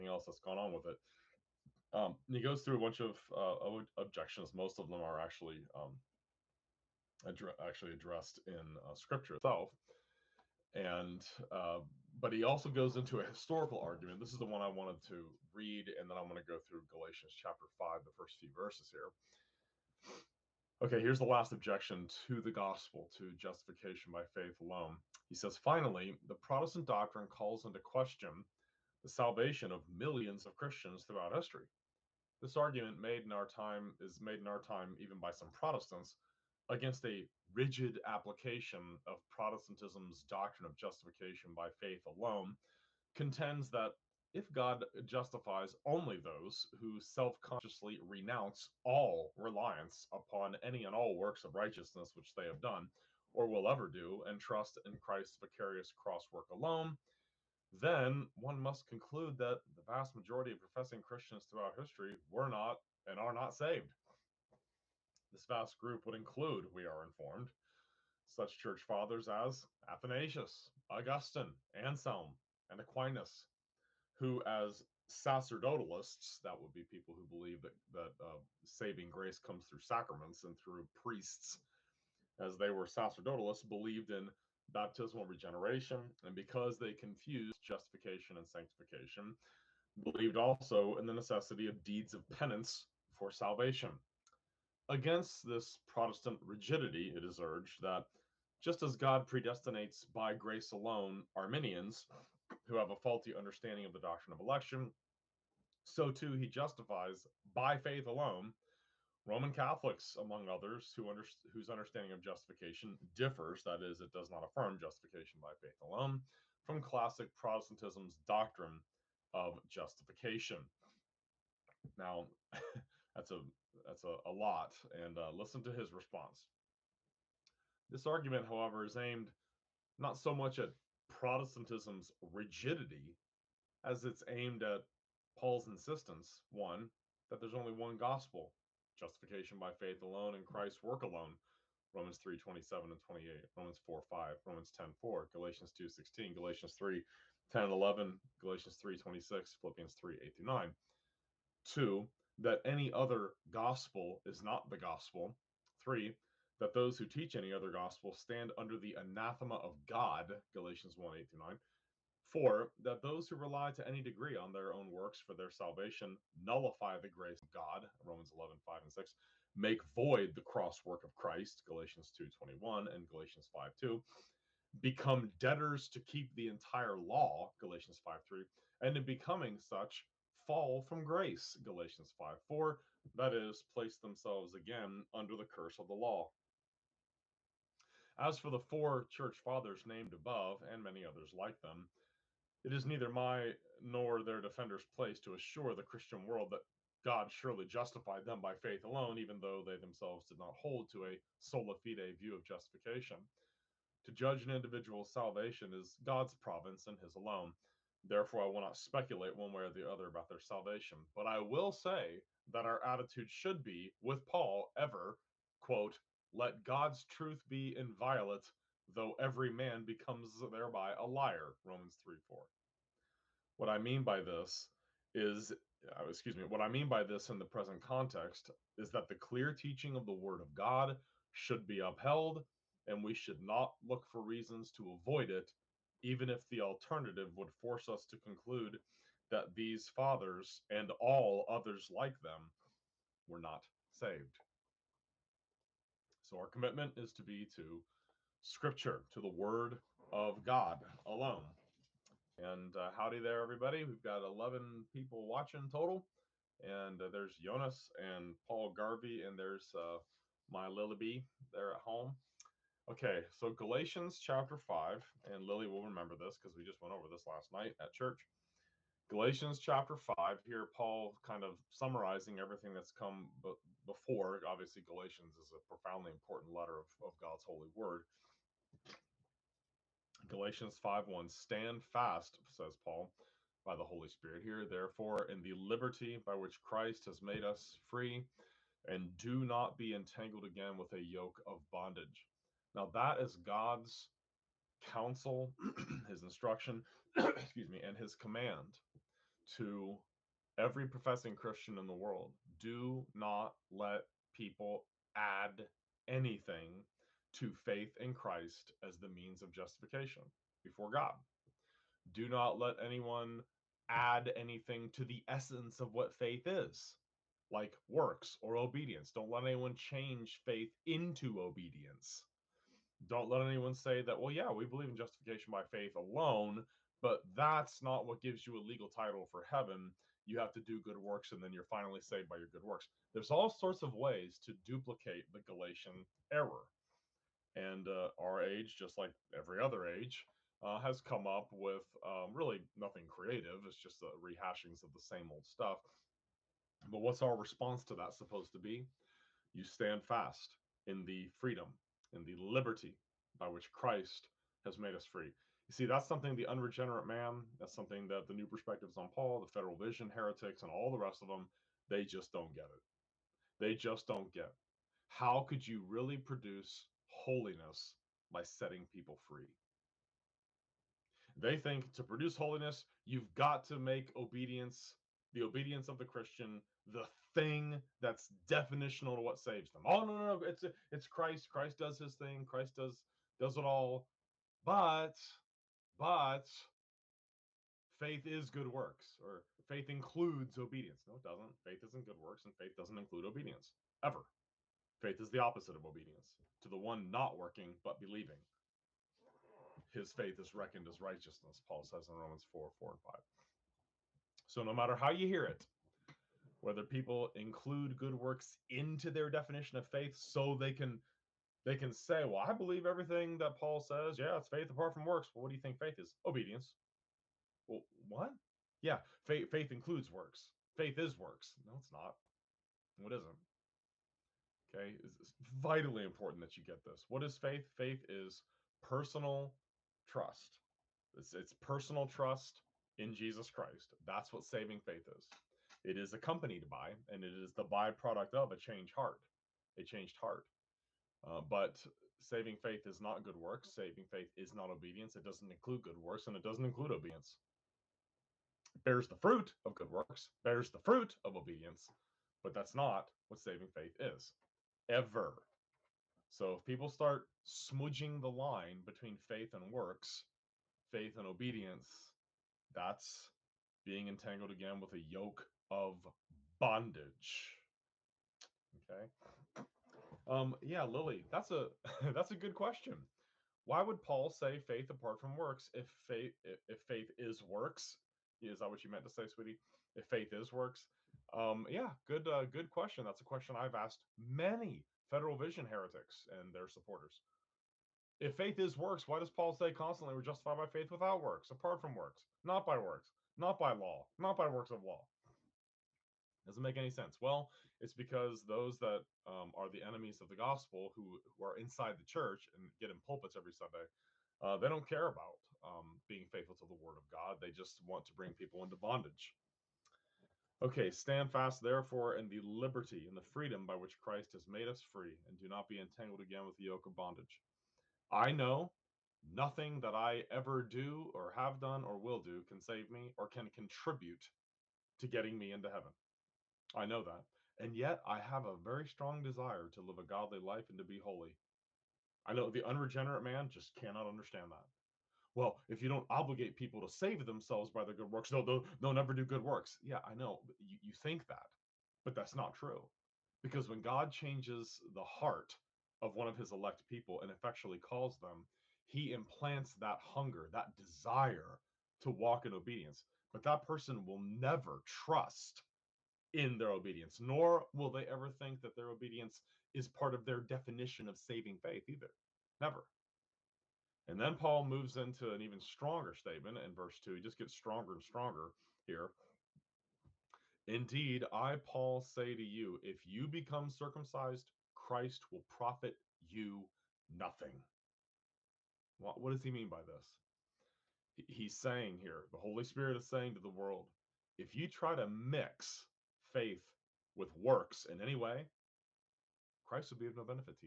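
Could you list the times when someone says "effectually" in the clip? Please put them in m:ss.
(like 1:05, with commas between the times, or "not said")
9:07.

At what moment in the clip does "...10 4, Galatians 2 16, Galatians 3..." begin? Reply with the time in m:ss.
2:24.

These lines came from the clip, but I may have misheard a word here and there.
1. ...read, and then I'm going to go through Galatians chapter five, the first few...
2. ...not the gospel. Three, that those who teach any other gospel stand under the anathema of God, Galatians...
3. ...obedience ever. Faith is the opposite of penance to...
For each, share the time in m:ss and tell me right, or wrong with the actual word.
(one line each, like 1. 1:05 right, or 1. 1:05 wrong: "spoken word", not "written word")
1. 0:15 right
2. 2:34 right
3. 6:33 wrong: "obedience", not "penance".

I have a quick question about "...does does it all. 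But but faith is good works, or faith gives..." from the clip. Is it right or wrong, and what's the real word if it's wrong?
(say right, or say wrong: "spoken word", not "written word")
wrong: "includes", not "gives".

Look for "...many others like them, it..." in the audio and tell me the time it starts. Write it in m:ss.
3:10.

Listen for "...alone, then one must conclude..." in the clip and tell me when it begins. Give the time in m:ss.
0:56.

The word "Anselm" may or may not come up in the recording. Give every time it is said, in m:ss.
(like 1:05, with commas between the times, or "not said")
1:11.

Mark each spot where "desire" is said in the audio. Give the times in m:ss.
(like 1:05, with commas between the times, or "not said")
8:49, 9:10.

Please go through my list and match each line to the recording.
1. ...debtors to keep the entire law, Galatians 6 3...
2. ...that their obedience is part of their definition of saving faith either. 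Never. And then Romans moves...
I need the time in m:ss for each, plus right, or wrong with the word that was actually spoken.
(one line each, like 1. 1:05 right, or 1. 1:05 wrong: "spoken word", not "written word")
1. 2:55 wrong: "5", not "6"
2. 9:18 wrong: "Paul", not "Romans".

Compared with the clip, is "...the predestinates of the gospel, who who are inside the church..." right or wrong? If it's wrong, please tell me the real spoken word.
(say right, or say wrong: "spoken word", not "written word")
wrong: "enemies", not "predestinates".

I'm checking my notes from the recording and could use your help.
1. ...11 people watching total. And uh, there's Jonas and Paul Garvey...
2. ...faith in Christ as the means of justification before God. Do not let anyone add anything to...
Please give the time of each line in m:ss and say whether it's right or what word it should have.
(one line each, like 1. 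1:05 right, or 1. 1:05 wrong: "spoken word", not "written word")
1. 4:14 right
2. 5:07 right.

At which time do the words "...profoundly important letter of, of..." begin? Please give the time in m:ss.
4:35.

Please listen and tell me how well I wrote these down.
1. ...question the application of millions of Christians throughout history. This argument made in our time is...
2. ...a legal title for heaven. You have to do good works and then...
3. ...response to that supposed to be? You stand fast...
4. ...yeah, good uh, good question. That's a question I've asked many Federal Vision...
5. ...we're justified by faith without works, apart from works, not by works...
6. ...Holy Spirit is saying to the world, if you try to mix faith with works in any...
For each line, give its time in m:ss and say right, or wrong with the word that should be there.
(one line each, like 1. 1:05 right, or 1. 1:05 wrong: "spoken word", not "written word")
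1. 0:27 wrong: "salvation", not "application"
2. 5:28 right
3. 5:47 right
4. 8:01 right
5. 8:10 right
6. 9:42 right.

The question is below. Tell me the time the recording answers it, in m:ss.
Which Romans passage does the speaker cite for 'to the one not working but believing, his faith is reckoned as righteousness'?
6:42.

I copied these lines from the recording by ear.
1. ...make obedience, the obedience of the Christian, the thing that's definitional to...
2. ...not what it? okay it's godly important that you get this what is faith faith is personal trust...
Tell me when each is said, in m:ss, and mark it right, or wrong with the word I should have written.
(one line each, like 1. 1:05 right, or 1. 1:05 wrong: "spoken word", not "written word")
1. 6:13 right
2. 7:01 wrong: "vitally", not "godly".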